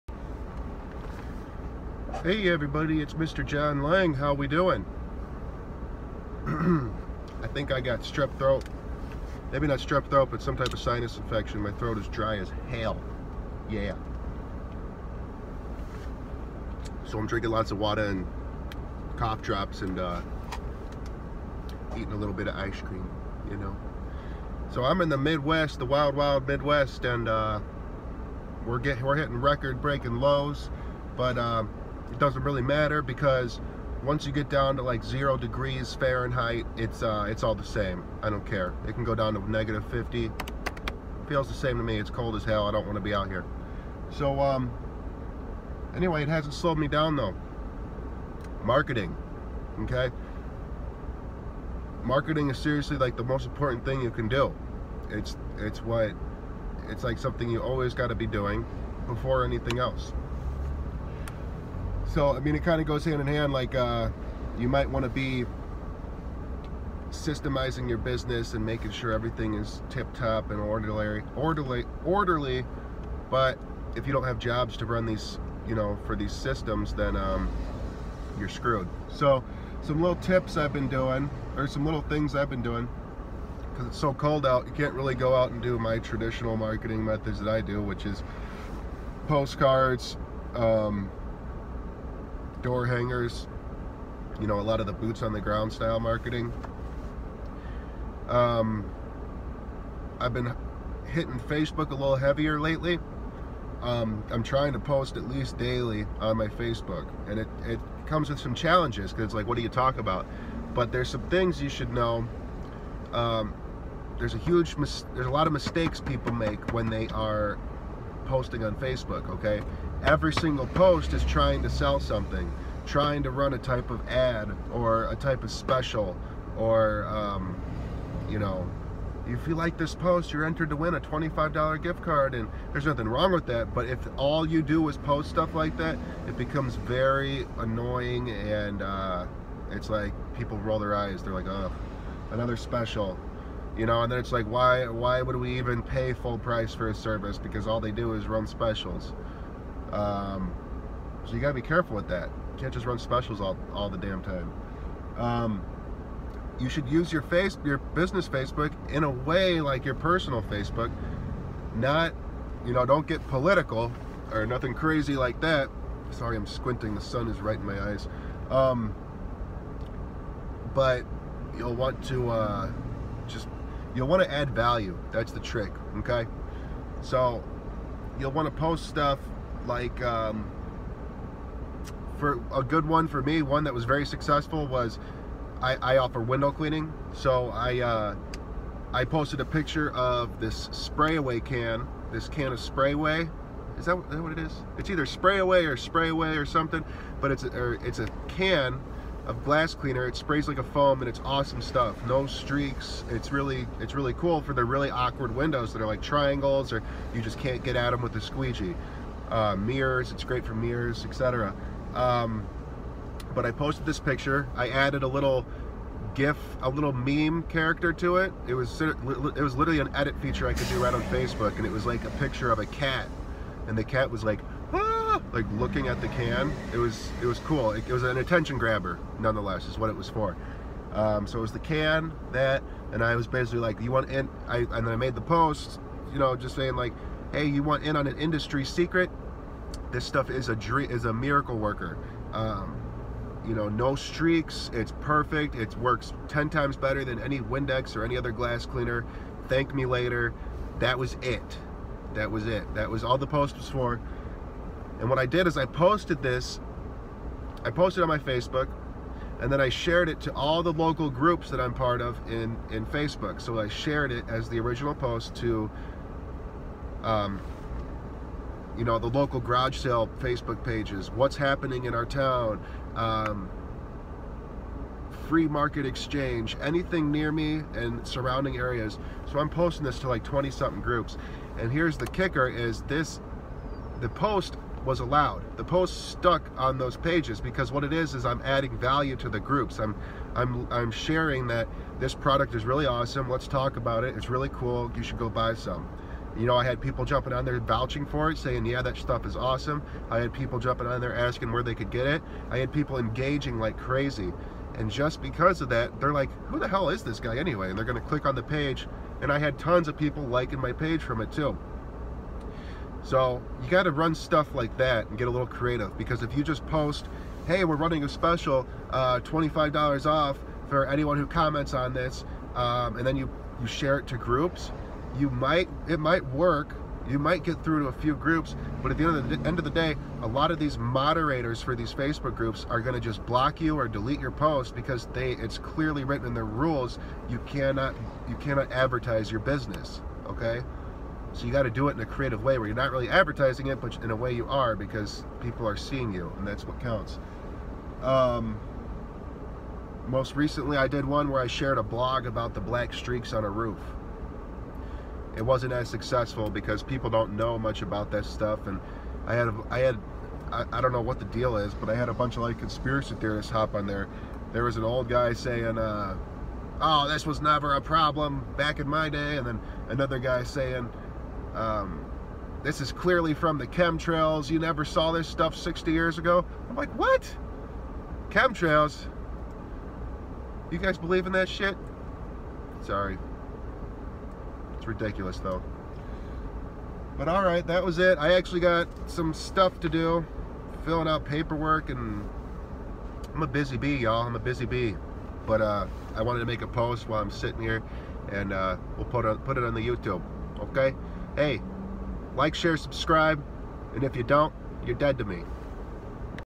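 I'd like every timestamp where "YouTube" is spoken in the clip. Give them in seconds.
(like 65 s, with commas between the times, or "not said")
399 s.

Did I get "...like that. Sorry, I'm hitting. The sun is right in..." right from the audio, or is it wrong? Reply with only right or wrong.
wrong.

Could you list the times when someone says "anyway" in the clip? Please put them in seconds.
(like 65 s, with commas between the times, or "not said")
45 s, 307 s.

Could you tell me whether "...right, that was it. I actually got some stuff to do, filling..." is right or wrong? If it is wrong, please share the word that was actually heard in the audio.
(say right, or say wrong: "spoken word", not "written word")
right.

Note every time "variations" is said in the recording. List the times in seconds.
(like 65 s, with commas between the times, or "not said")
not said.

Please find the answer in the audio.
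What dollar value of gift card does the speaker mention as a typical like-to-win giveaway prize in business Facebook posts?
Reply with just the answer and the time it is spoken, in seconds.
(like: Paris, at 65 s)
$25, at 130 s.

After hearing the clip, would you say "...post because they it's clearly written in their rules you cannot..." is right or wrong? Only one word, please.
right.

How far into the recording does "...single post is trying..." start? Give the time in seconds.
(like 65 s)
120 s.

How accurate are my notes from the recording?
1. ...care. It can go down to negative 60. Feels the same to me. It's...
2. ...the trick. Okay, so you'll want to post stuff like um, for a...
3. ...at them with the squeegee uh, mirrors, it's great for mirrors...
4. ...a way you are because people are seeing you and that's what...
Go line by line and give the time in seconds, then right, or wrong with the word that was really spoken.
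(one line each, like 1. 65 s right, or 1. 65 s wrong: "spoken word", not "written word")
1. 38 s wrong: "50", not "60"
2. 175 s right
3. 207 s right
4. 344 s right.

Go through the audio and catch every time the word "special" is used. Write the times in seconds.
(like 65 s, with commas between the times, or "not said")
125 s, 142 s, 148 s, 152 s, 318 s.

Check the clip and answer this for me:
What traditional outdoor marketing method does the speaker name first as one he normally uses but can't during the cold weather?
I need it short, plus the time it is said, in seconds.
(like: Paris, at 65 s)
Postcards, at 89 s.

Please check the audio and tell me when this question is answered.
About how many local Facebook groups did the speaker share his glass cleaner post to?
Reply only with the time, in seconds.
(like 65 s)
280 s.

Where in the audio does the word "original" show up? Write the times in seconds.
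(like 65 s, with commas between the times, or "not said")
264 s.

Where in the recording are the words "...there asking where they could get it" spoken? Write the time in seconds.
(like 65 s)
301 s.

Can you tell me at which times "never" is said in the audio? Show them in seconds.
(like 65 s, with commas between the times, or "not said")
367 s, 374 s.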